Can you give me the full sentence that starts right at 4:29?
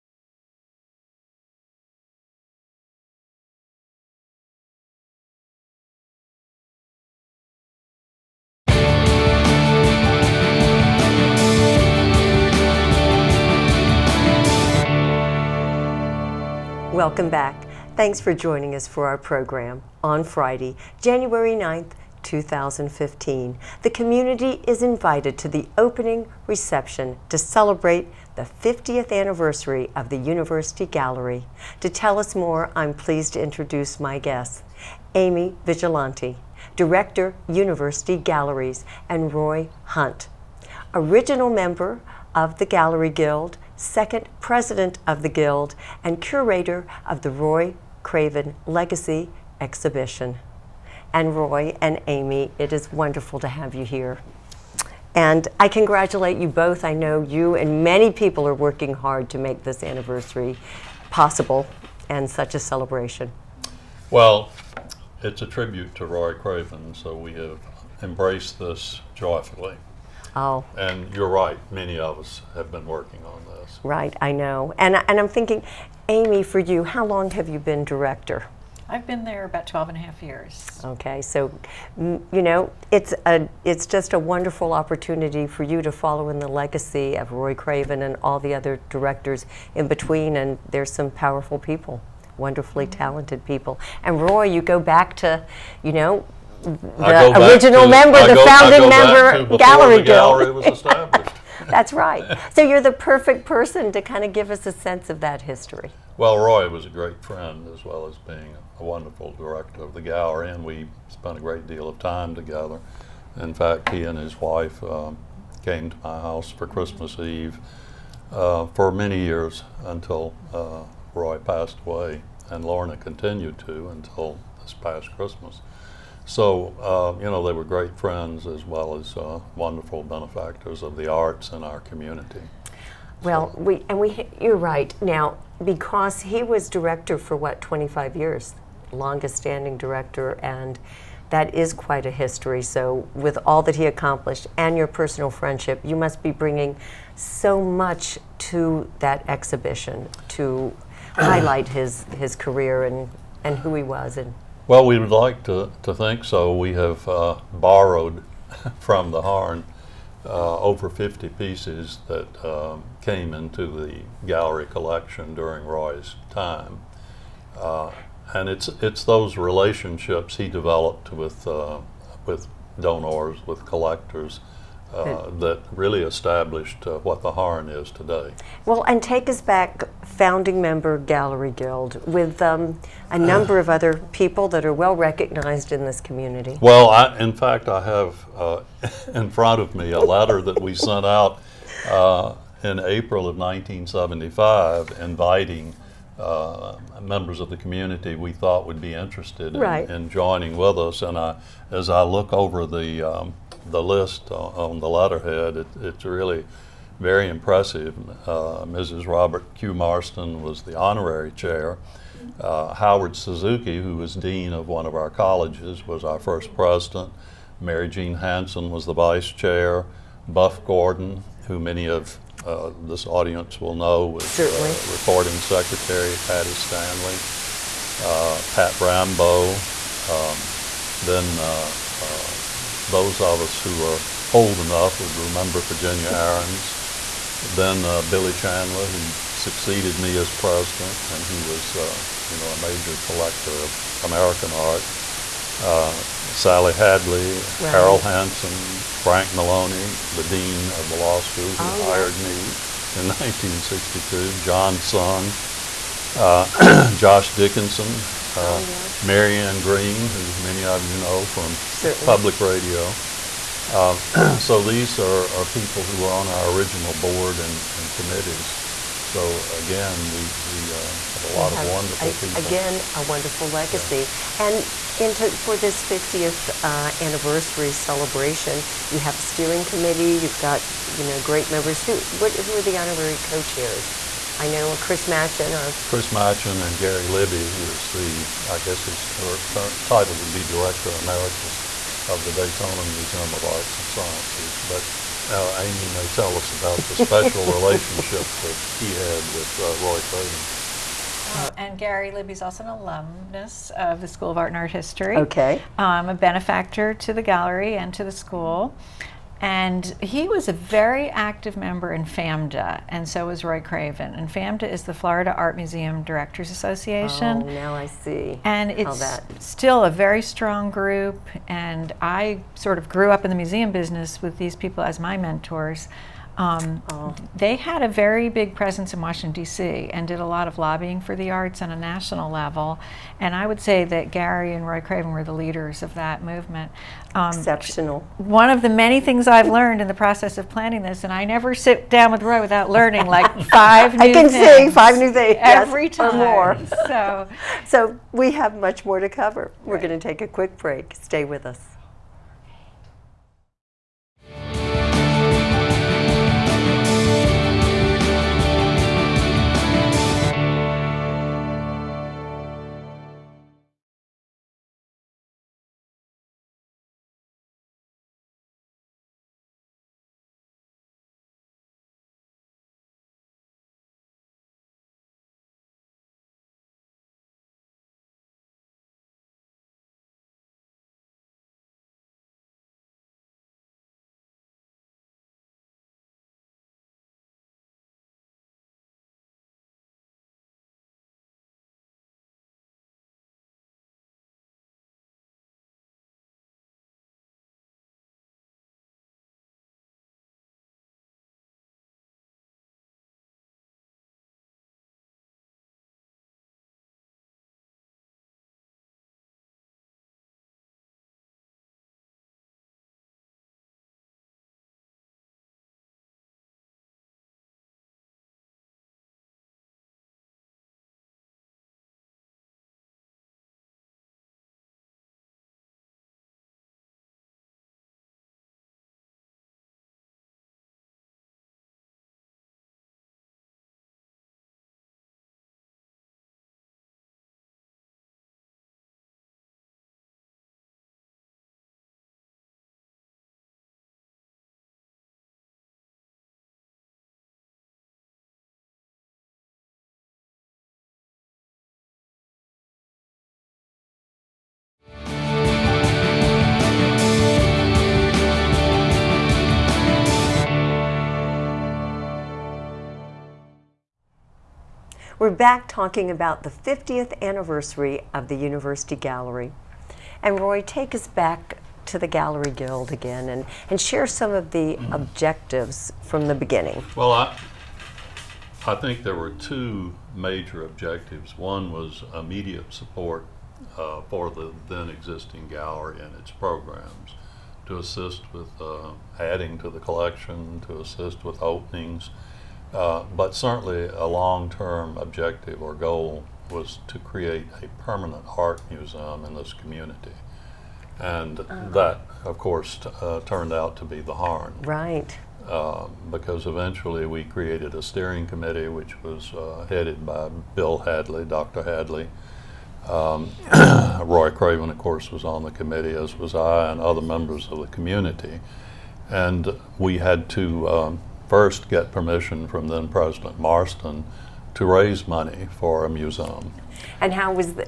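So again, we, we uh, had a lot of wonderful a, people.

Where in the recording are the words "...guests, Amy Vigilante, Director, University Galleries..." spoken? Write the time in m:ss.
0:34.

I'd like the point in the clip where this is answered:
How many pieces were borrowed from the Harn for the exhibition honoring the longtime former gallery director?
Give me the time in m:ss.
2:40.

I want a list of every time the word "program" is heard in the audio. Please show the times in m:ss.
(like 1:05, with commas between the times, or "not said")
0:19, 8:06.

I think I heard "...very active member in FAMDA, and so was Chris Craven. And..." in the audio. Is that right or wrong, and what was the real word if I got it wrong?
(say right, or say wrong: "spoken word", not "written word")
wrong: "Roy", not "Chris".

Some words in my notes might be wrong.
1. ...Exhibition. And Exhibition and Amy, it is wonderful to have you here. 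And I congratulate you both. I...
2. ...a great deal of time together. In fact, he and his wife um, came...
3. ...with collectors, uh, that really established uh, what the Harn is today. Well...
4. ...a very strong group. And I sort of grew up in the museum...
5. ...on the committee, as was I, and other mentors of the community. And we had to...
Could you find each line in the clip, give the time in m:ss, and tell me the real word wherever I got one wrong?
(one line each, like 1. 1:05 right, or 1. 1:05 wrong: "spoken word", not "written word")
1. 0:49 wrong: "Roy", not "Exhibition"
2. 1:51 right
3. 2:53 right
4. 5:19 right
5. 8:35 wrong: "members", not "mentors".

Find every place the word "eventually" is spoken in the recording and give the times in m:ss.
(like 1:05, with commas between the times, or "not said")
8:26.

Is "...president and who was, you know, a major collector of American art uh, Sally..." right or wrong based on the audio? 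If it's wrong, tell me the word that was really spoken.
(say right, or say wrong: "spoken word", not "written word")
right.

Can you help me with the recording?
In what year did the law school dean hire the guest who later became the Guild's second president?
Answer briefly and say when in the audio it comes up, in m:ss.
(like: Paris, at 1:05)
1962, at 4:13.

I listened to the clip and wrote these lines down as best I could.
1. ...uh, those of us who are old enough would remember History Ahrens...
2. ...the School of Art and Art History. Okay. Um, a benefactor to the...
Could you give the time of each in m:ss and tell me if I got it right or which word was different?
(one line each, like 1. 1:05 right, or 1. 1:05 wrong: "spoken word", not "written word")
1. 3:52 wrong: "Virginia", not "History"
2. 5:04 right.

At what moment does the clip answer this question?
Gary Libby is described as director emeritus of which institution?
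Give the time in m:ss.
4:52.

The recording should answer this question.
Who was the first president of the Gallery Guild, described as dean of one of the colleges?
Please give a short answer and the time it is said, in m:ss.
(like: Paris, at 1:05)
Howard Suzuki, at 3:32.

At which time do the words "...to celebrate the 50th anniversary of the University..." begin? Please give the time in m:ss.
0:27.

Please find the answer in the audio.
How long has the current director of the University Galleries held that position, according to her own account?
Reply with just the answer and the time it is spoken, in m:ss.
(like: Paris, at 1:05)
12 and a half years, at 1:19.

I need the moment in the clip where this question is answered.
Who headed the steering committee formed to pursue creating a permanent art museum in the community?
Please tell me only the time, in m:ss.
8:30.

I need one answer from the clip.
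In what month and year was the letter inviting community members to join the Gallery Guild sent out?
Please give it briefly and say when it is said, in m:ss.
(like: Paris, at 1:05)
April 1975, at 3:12.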